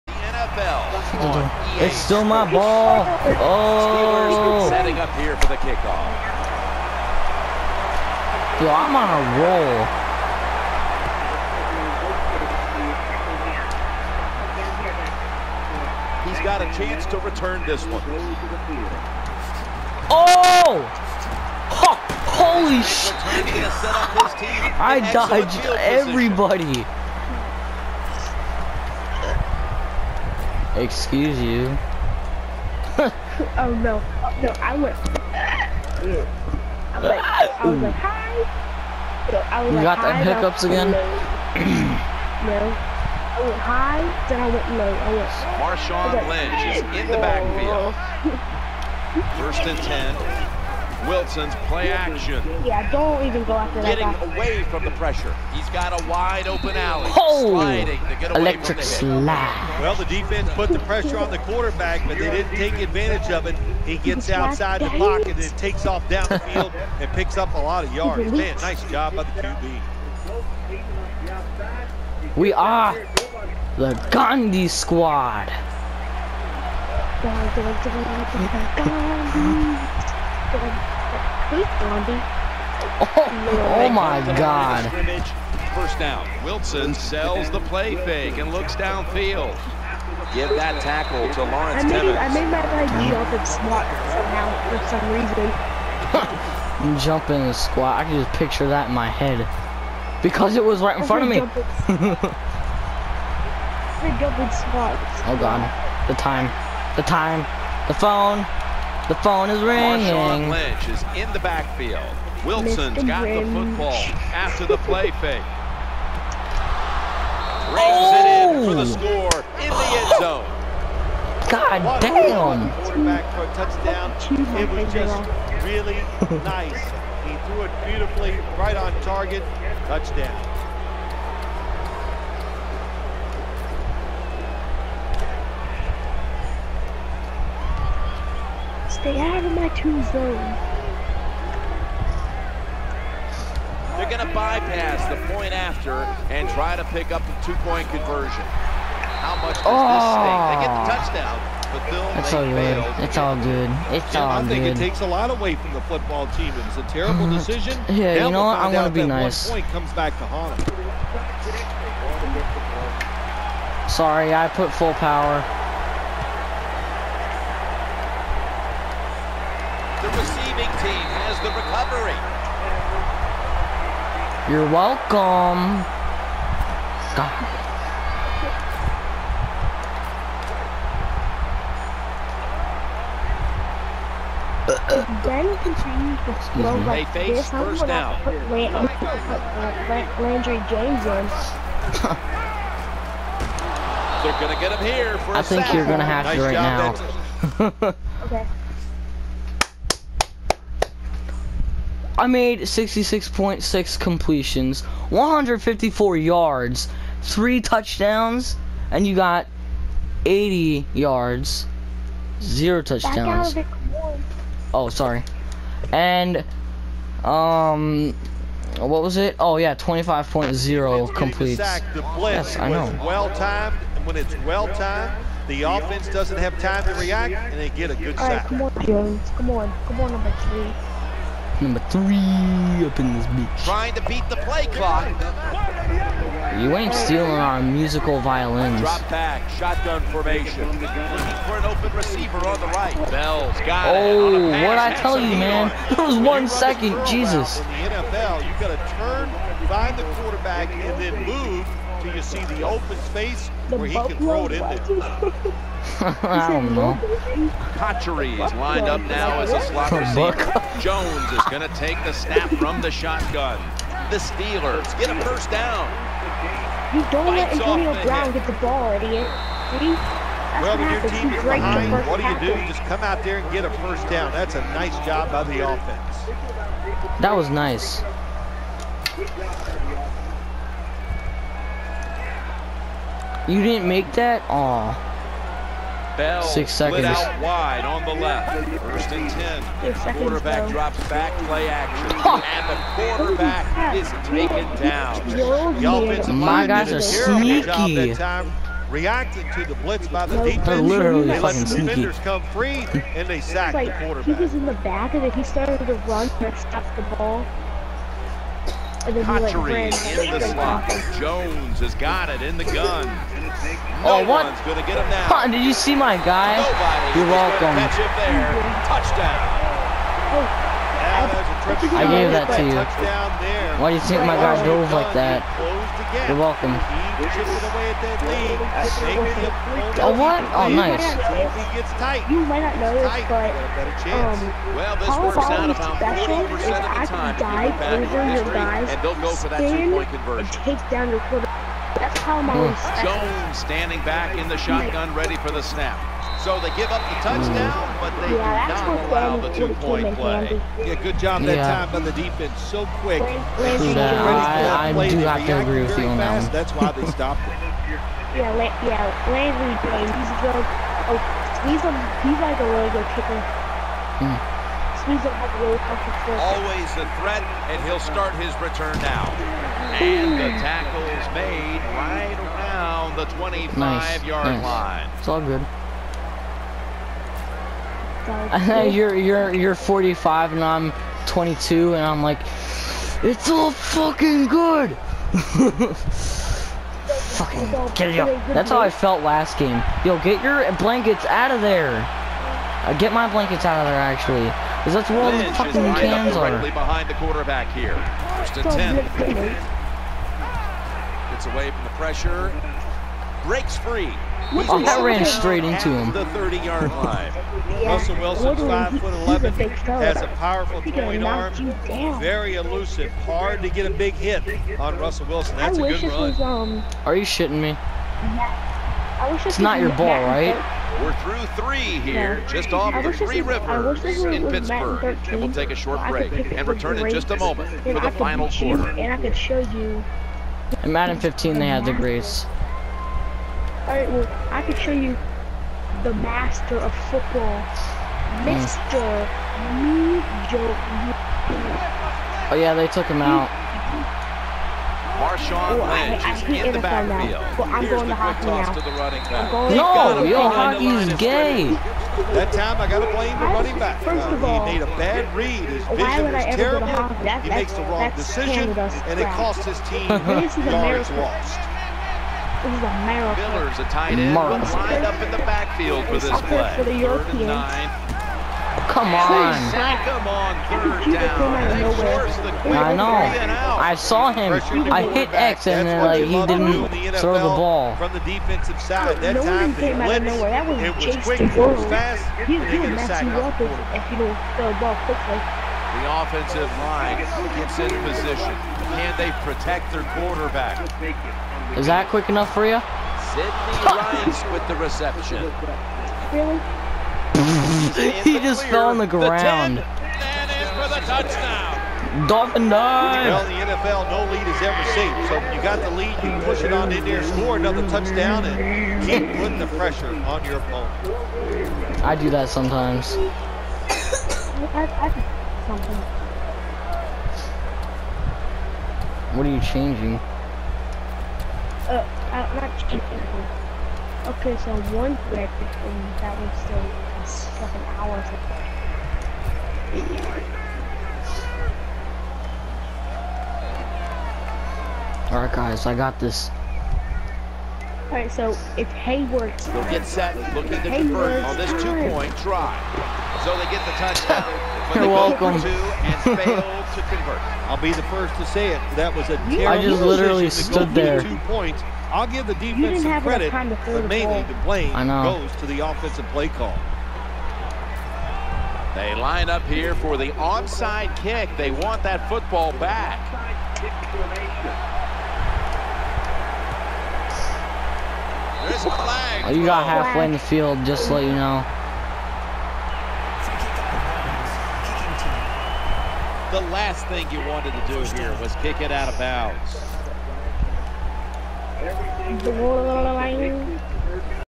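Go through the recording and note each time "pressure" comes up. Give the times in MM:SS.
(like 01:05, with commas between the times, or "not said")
00:54, 01:00, 06:41, 08:29.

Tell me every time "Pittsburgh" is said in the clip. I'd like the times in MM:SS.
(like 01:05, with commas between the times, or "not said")
07:04.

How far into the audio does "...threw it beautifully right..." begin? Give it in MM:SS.
02:07.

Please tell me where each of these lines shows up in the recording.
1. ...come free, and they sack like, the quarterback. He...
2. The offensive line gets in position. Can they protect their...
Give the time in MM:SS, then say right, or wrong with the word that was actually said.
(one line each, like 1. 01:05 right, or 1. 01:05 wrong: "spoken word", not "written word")
1. 05:02 right
2. 08:05 right.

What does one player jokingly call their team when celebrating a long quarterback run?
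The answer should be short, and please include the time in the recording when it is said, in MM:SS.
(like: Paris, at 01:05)
Gandhi Squad, at 01:14.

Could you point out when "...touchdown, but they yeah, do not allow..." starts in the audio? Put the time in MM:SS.
05:47.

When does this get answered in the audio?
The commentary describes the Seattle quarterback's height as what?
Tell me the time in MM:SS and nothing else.
06:48.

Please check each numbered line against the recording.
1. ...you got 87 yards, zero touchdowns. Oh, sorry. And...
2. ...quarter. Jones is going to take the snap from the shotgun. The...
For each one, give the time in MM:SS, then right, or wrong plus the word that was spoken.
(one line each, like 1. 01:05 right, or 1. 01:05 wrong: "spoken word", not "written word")
1. 03:29 wrong: "80", not "87"
2. 04:19 wrong: "receiver", not "quarter".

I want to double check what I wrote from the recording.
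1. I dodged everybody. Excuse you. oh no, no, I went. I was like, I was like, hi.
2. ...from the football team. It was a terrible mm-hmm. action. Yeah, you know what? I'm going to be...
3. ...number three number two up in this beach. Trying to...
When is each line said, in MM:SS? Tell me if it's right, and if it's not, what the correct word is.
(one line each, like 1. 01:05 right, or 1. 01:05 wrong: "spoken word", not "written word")
1. 00:24 right
2. 02:35 wrong: "decision", not "action"
3. 03:50 wrong: "three", not "two".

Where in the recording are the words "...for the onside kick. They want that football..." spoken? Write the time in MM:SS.
09:19.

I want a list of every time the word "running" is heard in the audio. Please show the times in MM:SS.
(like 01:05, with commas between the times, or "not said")
07:28, 07:33.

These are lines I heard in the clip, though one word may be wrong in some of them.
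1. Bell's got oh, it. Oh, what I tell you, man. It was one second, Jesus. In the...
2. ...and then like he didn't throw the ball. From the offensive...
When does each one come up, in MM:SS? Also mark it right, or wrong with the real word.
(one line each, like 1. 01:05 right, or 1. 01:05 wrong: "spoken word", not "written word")
1. 04:03 right
2. 07:55 wrong: "defensive", not "offensive".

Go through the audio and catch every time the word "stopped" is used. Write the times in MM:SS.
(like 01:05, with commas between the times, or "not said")
05:06, 05:57.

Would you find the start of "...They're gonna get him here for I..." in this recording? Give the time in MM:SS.
03:14.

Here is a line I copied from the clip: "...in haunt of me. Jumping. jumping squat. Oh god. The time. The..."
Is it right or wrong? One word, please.
wrong.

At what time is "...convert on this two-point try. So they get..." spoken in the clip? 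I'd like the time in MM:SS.
09:00.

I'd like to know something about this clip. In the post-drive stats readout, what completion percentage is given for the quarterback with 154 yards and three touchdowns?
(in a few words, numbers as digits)
66.6.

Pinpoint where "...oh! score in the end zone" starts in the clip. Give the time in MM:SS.
01:58.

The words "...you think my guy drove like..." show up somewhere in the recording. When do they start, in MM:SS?
05:23.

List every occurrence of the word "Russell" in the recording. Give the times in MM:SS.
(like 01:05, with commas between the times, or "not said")
06:47, 06:54.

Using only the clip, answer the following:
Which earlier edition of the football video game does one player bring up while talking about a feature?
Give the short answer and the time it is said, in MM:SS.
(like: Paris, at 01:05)
Madden 15, at 07:10.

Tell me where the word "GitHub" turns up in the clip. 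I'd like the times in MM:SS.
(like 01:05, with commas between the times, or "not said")
not said.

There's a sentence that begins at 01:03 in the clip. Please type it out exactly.
He gets outside the pocket and takes off down the field and picks up a lot of yards.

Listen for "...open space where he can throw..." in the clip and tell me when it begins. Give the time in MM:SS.
04:12.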